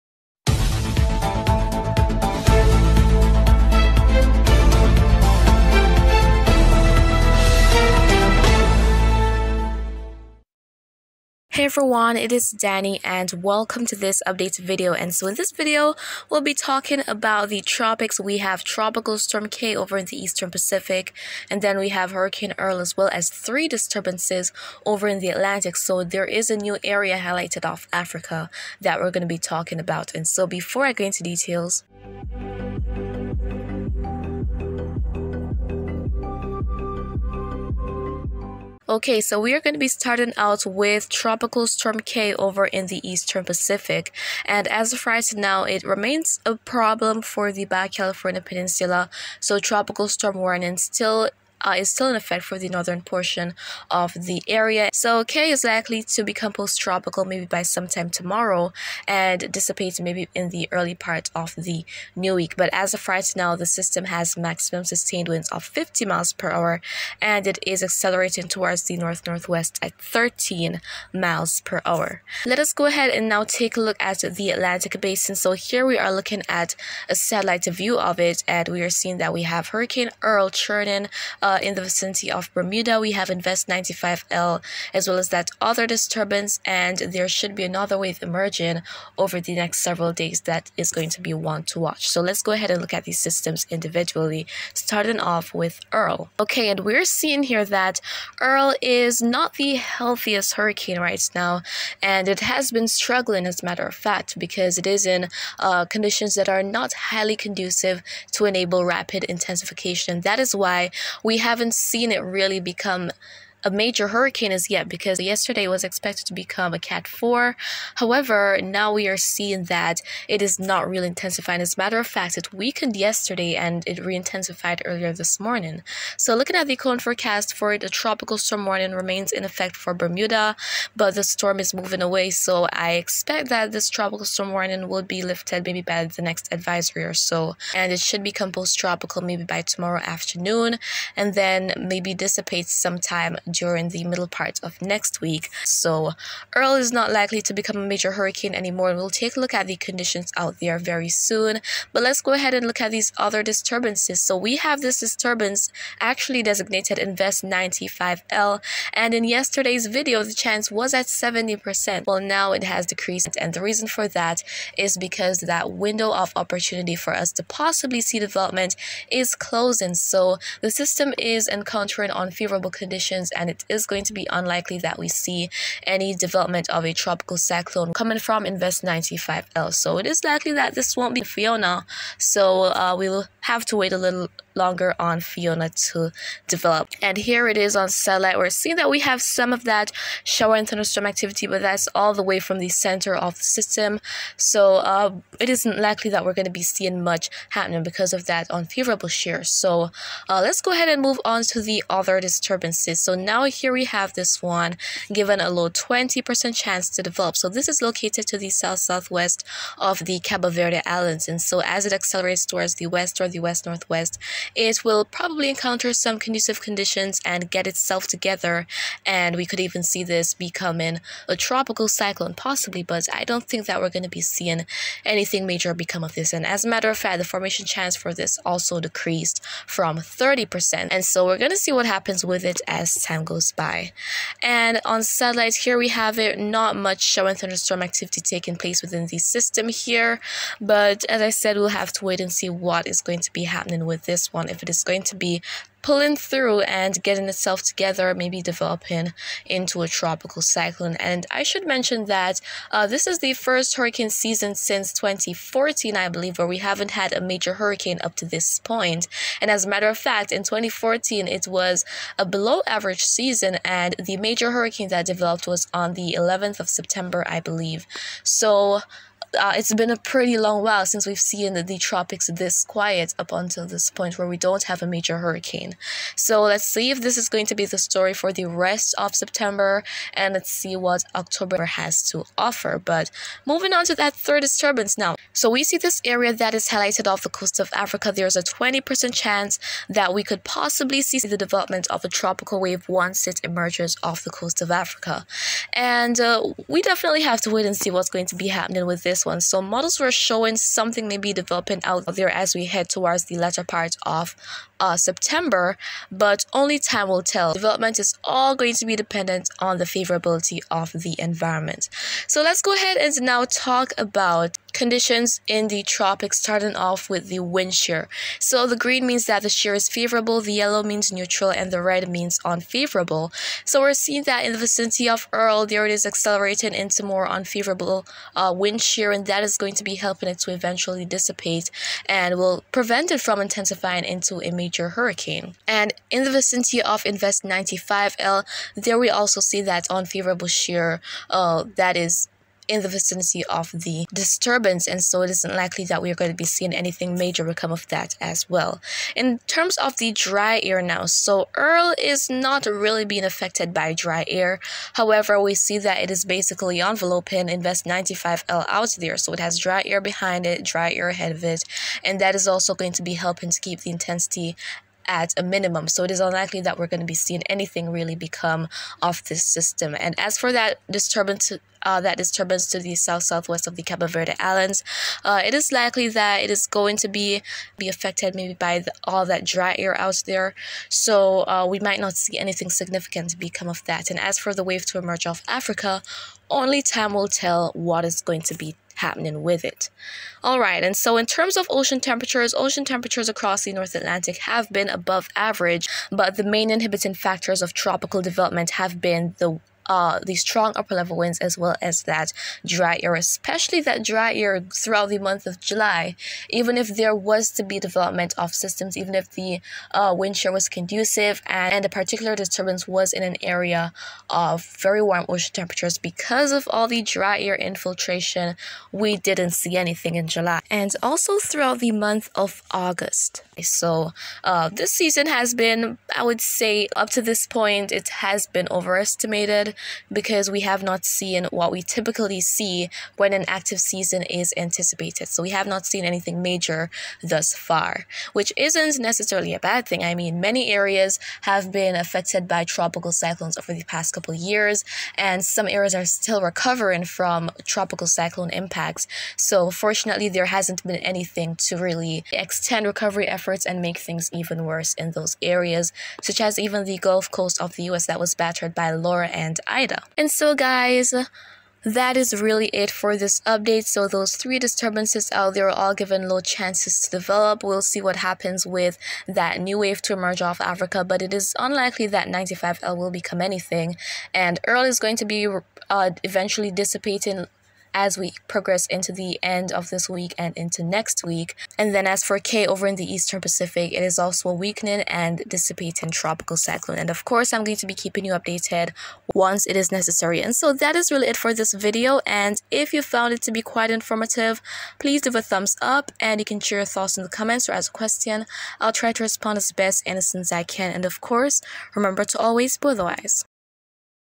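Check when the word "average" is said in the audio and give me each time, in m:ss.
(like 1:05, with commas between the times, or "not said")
4:22, 6:35.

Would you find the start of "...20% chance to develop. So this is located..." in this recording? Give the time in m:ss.
3:25.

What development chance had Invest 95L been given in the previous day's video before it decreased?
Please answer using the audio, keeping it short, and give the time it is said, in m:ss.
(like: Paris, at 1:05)
70%, at 2:41.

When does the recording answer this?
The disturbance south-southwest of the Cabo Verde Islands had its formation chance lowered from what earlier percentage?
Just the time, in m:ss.
3:49.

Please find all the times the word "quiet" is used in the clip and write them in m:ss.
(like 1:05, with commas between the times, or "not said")
4:32.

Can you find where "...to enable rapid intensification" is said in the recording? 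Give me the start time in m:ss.
1:48.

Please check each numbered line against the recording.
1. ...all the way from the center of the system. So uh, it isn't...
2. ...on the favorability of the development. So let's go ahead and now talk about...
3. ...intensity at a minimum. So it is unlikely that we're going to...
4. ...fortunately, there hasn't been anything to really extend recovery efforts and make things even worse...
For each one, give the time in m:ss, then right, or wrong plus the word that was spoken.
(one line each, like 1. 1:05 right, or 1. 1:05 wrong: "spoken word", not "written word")
1. 3:11 right
2. 5:09 wrong: "environment", not "development"
3. 6:03 right
4. 7:29 right.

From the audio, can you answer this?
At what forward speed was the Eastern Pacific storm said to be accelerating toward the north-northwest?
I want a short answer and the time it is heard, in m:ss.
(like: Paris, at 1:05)
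13 miles per hour, at 1:10.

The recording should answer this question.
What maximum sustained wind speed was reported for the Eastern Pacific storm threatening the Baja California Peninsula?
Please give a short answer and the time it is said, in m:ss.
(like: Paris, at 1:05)
50 miles per hour, at 1:05.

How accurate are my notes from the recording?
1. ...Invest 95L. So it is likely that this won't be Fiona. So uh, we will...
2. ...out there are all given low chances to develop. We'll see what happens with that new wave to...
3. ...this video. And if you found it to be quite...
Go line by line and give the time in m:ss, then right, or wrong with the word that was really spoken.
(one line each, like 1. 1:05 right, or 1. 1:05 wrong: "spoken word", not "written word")
1. 2:58 right
2. 7:45 right
3. 8:11 right.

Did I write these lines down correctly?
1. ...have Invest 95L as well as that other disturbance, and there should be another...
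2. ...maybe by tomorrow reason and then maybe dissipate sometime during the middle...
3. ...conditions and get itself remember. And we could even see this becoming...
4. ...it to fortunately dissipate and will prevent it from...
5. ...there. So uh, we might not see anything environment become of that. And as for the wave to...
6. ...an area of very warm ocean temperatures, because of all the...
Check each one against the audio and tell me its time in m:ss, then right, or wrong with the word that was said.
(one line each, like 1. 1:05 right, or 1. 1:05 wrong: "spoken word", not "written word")
1. 1:23 right
2. 2:19 wrong: "afternoon", not "reason"
3. 3:36 wrong: "together", not "remember"
4. 5:30 wrong: "eventually", not "fortunately"
5. 6:20 wrong: "significant", not "environment"
6. 6:53 right.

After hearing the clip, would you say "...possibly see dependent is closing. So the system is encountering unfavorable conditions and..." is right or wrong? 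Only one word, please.
wrong.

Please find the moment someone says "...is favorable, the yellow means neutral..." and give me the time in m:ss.
5:19.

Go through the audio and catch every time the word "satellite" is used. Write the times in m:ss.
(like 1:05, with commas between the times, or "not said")
1:17, 3:07, 3:55.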